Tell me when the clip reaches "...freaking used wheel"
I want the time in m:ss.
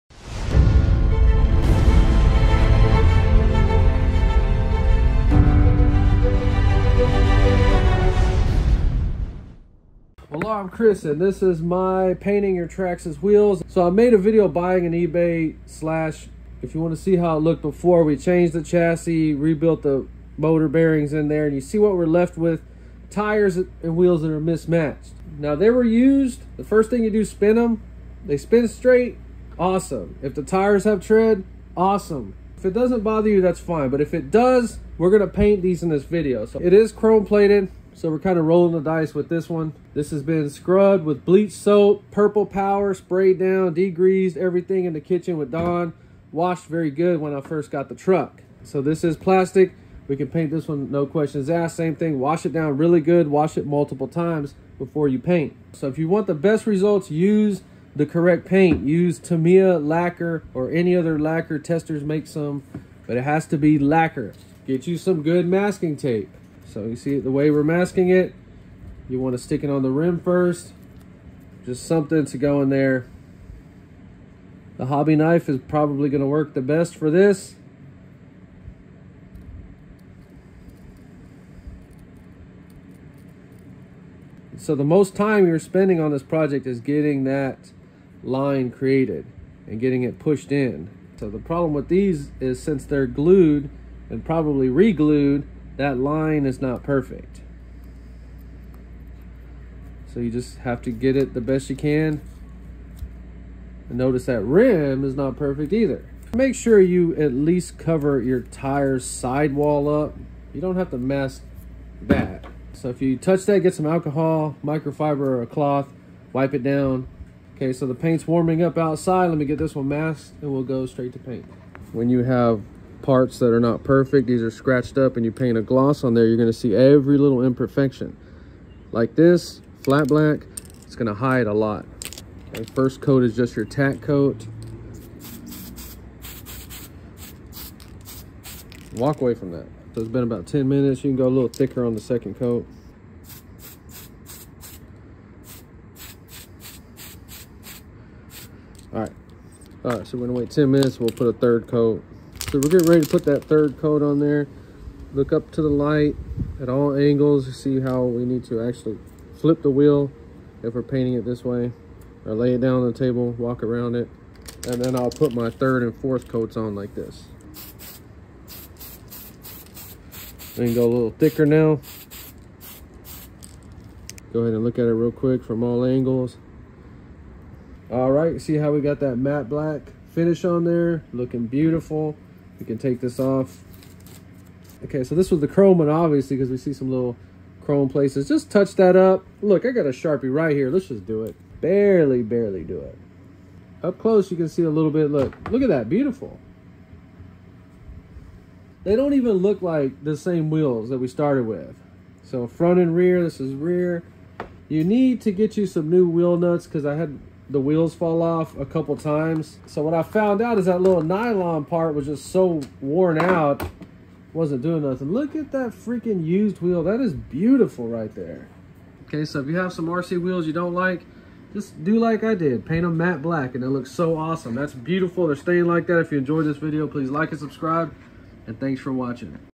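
3:35.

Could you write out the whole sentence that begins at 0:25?
Now they were used, the first thing you do, spin them.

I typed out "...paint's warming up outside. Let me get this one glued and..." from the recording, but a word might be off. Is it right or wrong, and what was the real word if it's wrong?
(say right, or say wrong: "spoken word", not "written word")
wrong: "masked", not "glued".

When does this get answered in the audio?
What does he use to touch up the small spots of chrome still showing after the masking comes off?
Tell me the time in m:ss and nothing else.
3:09.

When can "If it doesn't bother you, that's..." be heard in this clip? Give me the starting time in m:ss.
0:32.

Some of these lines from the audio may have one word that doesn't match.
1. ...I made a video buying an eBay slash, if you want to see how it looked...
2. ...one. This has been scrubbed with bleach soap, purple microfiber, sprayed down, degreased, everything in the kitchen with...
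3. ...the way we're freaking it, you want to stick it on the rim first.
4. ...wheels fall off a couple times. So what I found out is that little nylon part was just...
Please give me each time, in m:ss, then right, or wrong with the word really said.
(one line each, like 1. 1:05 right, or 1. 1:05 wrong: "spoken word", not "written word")
1. 0:13 right
2. 0:39 wrong: "power", not "microfiber"
3. 1:07 wrong: "masking", not "freaking"
4. 3:27 right.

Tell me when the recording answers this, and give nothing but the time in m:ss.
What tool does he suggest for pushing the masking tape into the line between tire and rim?
1:14.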